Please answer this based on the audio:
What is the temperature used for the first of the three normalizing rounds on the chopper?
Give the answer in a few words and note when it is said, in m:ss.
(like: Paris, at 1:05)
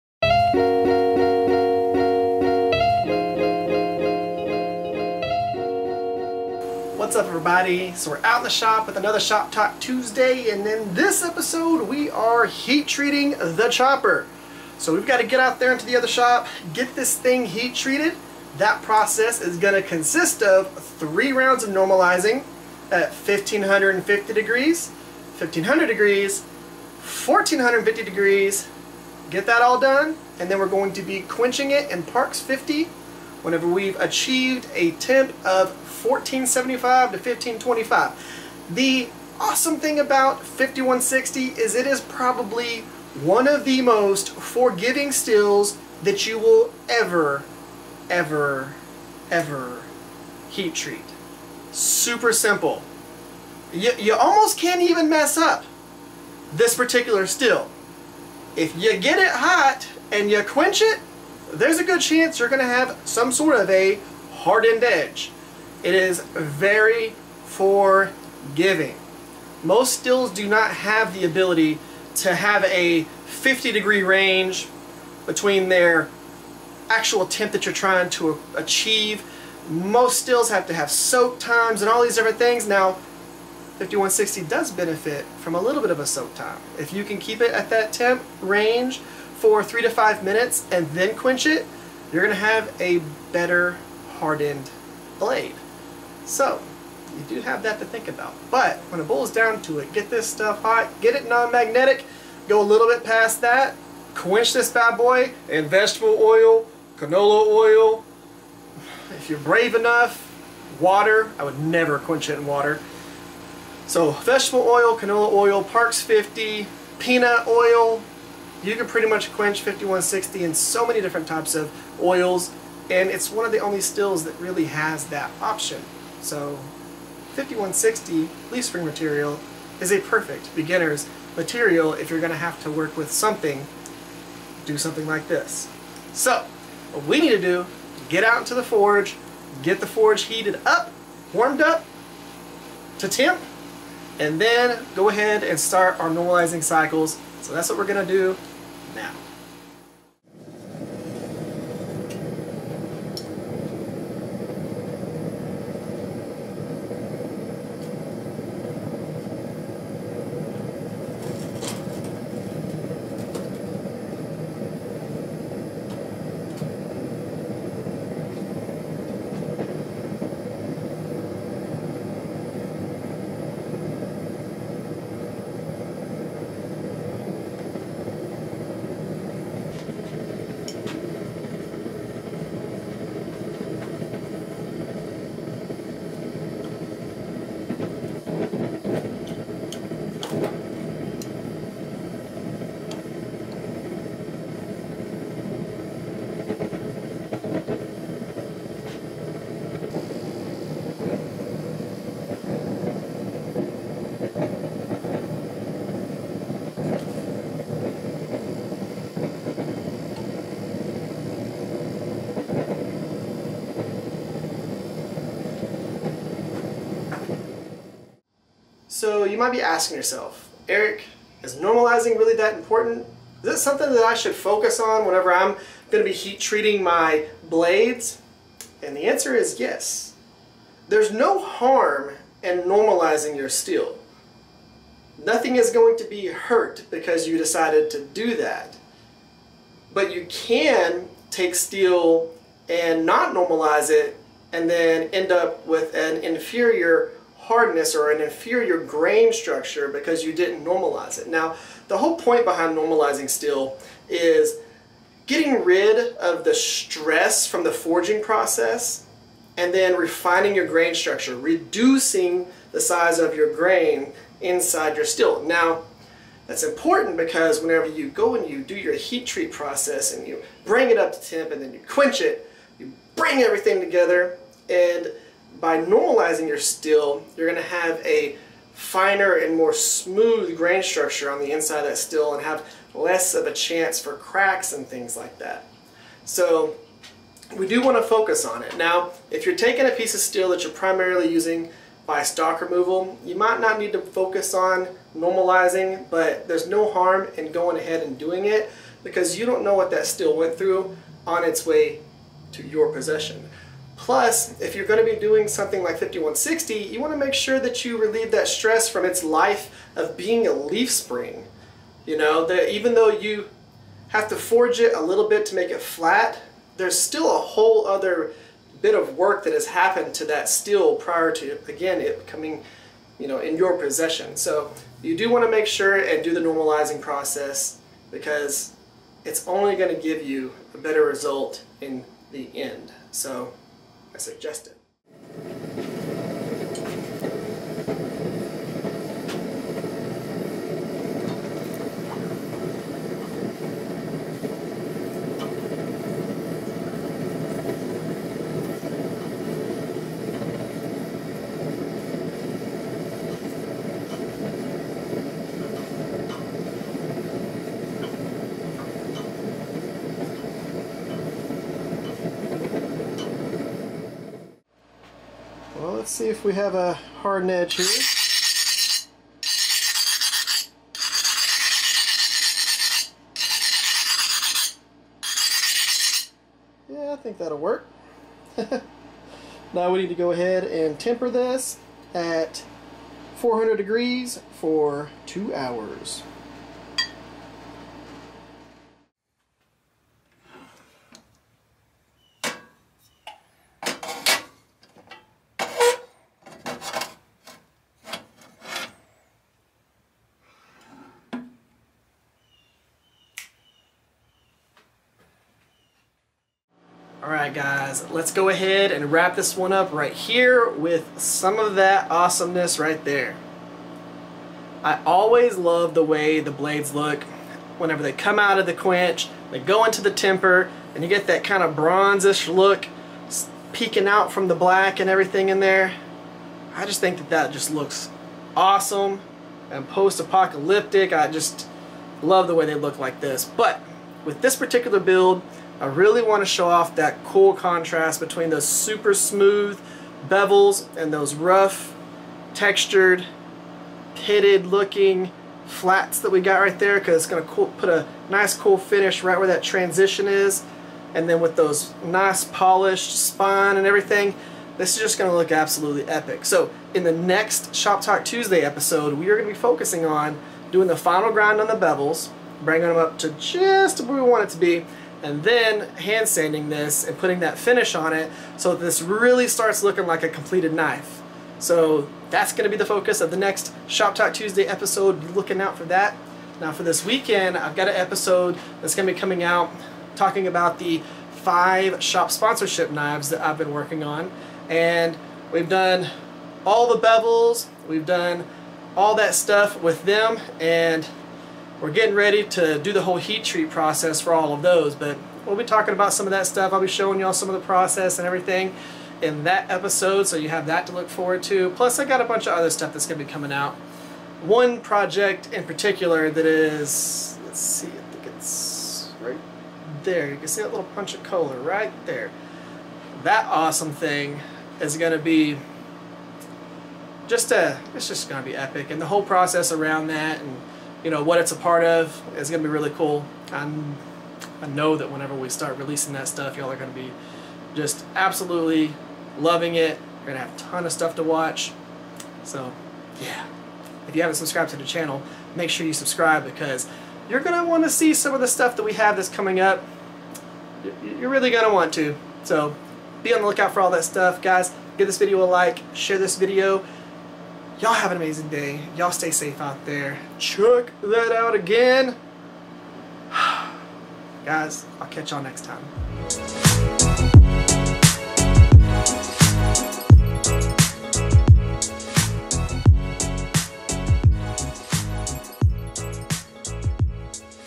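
1550 degrees, at 0:23.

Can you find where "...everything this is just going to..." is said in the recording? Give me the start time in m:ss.
7:33.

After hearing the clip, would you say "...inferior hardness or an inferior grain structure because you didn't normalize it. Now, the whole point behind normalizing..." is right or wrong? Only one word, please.
right.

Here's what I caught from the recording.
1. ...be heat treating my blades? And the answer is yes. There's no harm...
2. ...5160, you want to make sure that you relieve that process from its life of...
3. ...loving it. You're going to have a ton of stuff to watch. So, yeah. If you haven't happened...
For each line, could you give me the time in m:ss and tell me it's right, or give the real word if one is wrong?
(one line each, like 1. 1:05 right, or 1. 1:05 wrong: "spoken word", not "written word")
1. 3:46 right
2. 5:05 wrong: "stress", not "process"
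3. 8:49 wrong: "subscribed", not "happened".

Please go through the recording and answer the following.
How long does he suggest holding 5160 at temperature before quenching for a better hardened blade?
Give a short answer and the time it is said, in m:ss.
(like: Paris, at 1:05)
three to five minutes, at 1:29.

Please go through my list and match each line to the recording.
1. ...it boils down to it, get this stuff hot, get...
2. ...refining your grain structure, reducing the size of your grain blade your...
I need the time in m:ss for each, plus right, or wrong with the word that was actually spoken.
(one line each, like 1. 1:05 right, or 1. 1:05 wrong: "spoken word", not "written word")
1. 1:39 right
2. 4:19 wrong: "inside", not "blade".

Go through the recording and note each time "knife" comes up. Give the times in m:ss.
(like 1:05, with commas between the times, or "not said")
7:50.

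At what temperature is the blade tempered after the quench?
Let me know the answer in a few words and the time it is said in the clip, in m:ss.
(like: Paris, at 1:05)
400 degrees, at 6:23.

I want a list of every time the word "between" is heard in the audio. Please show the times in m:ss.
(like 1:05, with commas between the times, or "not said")
1:15, 7:18.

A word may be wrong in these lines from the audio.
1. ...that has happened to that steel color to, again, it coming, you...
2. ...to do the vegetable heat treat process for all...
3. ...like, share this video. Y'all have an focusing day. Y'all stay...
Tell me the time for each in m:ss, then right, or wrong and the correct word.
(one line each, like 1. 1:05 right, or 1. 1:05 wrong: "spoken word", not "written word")
1. 5:19 wrong: "prior", not "color"
2. 8:12 wrong: "whole", not "vegetable"
3. 9:05 wrong: "amazing", not "focusing".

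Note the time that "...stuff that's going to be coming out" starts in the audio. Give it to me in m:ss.
8:22.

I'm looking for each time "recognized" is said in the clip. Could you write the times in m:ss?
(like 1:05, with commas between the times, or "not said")
not said.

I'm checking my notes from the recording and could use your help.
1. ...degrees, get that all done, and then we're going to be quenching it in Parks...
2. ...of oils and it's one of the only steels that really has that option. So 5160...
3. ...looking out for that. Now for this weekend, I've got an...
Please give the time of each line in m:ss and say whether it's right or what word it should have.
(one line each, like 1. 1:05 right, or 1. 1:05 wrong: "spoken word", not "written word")
1. 0:28 right
2. 2:01 right
3. 7:55 right.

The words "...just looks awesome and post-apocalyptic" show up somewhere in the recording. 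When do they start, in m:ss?
7:07.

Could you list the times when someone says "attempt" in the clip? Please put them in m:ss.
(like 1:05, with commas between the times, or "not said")
1:17.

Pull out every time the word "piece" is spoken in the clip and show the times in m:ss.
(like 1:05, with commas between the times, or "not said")
4:49.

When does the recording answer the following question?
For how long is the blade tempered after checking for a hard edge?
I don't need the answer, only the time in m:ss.
6:25.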